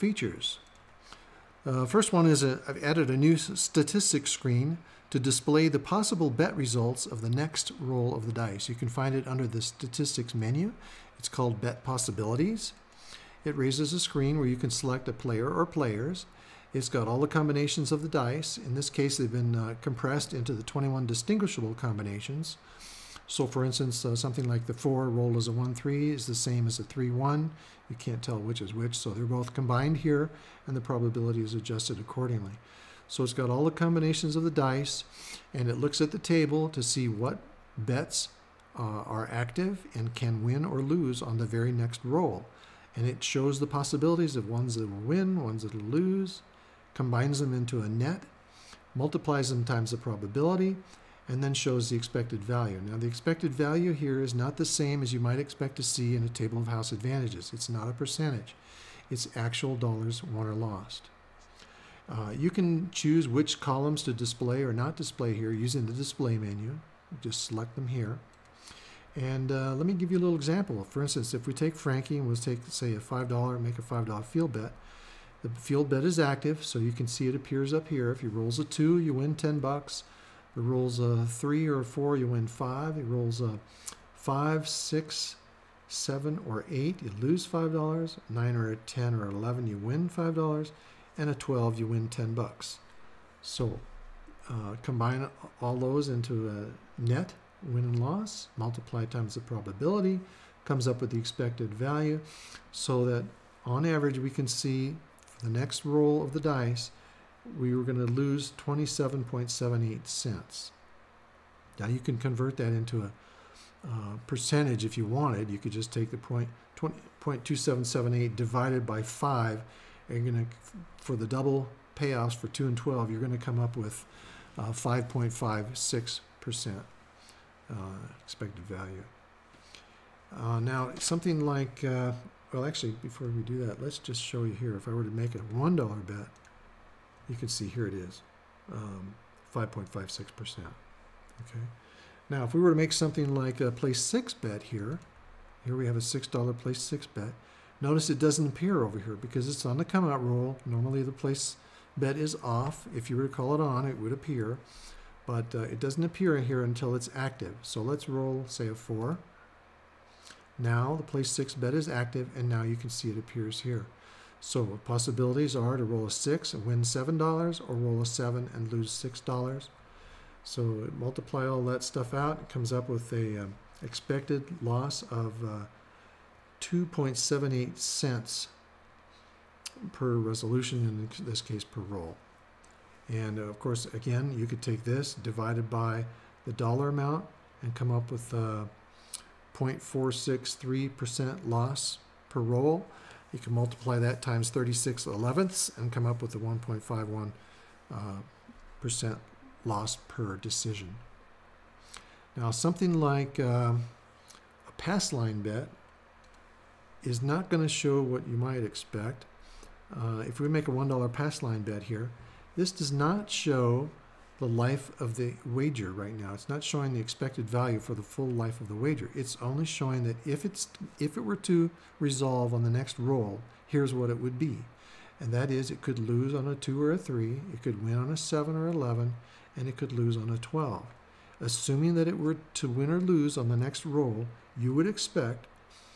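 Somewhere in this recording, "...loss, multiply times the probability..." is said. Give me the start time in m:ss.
1:37.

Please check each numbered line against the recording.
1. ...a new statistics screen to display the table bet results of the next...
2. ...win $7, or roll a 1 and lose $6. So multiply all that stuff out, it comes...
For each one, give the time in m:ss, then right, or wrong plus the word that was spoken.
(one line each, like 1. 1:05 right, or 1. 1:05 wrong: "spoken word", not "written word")
1. 0:03 wrong: "possible", not "table"
2. 2:46 wrong: "7", not "1".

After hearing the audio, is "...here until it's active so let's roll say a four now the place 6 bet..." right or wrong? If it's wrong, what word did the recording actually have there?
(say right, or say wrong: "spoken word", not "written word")
right.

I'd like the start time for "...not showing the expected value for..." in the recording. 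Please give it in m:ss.
3:36.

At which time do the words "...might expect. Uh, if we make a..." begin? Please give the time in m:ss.
3:28.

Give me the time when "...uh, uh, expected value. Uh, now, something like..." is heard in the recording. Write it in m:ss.
2:06.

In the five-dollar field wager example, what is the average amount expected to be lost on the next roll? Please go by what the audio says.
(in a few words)
27.78 cents.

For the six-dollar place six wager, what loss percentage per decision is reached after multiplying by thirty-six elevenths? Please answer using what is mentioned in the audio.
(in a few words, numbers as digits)
1.51%.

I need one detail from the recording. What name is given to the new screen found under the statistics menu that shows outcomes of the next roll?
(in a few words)
Bet Possibilities.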